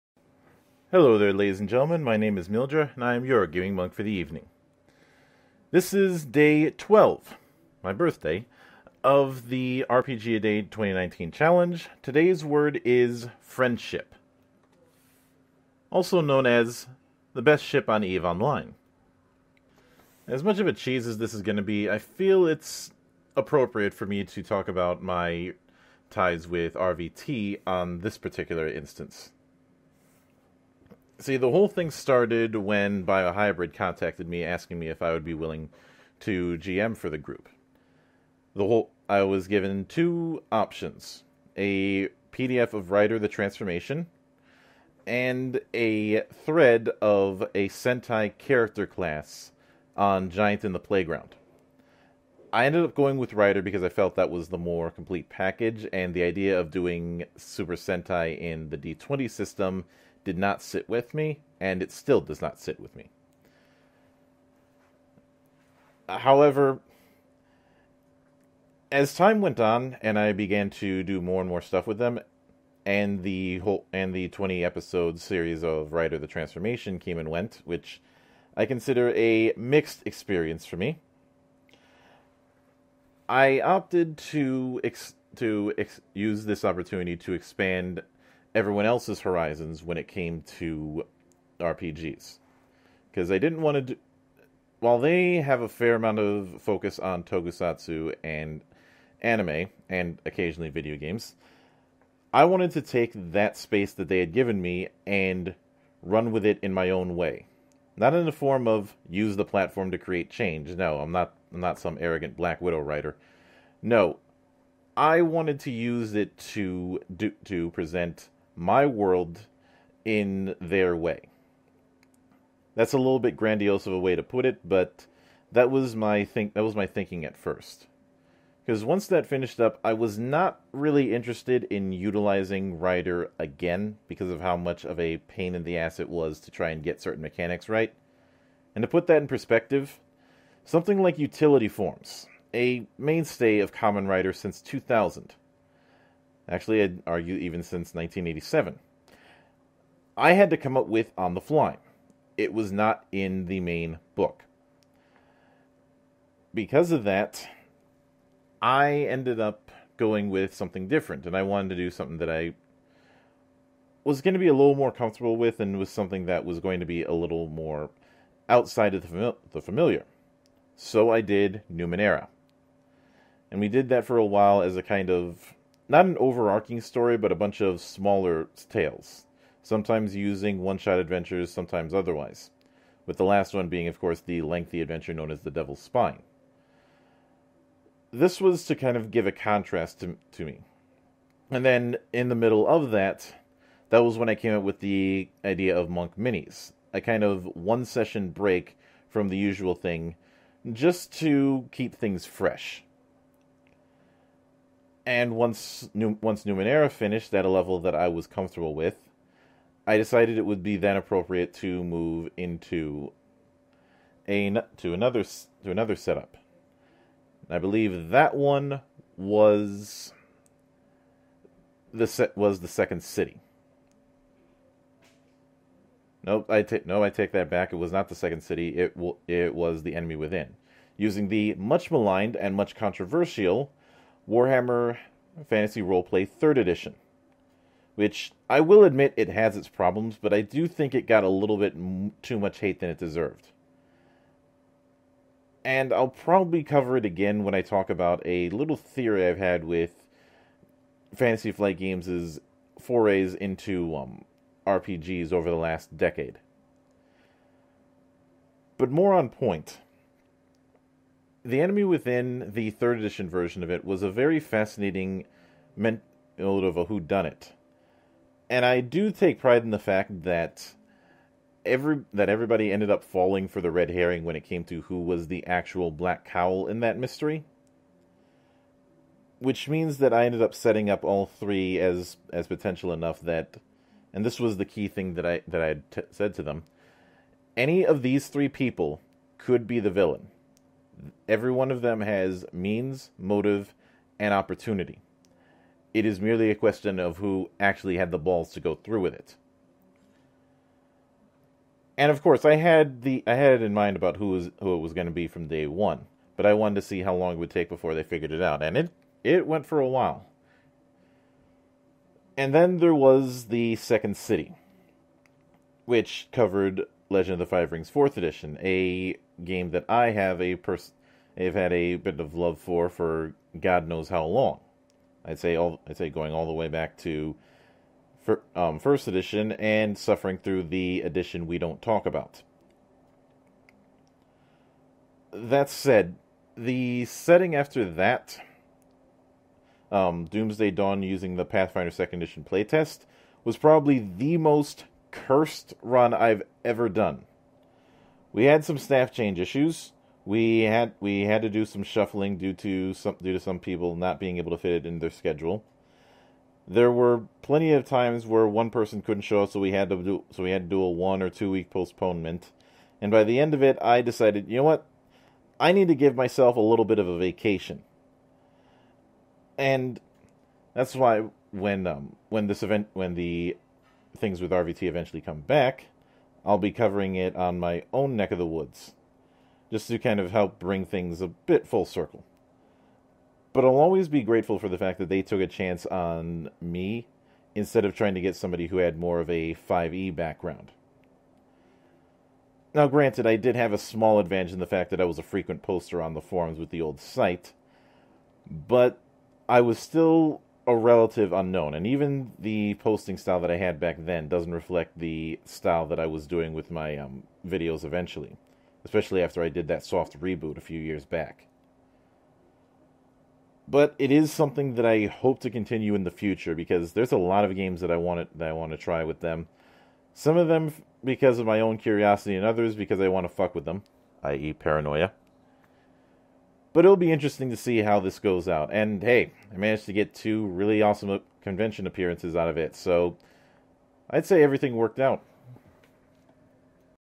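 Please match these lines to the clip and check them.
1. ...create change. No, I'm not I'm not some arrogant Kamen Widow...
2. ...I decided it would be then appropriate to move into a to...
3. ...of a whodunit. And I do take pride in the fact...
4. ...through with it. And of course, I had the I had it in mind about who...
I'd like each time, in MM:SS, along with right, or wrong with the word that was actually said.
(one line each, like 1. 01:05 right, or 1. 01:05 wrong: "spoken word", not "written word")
1. 01:49 wrong: "Black", not "Kamen"
2. 03:29 right
3. 04:26 right
4. 04:58 right.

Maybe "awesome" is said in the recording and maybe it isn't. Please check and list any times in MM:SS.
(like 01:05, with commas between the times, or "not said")
07:10.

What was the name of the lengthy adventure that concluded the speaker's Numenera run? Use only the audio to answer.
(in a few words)
The Devil's Spine.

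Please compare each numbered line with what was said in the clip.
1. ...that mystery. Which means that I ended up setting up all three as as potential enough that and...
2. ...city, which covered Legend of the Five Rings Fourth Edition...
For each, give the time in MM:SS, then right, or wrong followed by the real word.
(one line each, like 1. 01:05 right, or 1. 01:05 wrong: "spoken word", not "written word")
1. 04:36 right
2. 05:14 right.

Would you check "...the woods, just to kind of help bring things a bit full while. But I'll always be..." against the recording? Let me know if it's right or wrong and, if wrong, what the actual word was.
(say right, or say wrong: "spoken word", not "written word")
wrong: "circle", not "while".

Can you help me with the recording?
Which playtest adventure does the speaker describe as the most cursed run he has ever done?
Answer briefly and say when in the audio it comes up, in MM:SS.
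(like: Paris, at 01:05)
Doomsday Dawn, at 05:40.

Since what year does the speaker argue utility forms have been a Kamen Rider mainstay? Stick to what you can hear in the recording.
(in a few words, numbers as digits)
1987.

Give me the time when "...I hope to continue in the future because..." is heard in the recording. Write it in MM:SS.
06:54.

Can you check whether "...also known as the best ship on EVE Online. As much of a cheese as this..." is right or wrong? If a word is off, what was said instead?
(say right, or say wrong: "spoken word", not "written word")
right.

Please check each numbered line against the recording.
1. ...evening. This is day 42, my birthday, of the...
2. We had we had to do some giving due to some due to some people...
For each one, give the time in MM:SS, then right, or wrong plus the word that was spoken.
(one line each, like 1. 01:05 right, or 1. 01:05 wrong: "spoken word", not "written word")
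1. 00:04 wrong: "12", not "42"
2. 05:50 wrong: "shuffling", not "giving".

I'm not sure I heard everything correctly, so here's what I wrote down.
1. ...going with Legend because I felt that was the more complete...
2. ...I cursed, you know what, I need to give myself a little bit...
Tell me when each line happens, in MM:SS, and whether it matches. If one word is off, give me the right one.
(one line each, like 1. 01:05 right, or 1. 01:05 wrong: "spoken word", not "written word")
1. 00:52 wrong: "Rider", not "Legend"
2. 06:03 wrong: "decided", not "cursed".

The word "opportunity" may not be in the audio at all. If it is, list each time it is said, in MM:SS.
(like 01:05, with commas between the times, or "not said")
01:26, 04:54.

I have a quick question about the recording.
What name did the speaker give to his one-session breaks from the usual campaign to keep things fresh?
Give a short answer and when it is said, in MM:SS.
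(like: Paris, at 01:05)
Monk Minis, at 03:15.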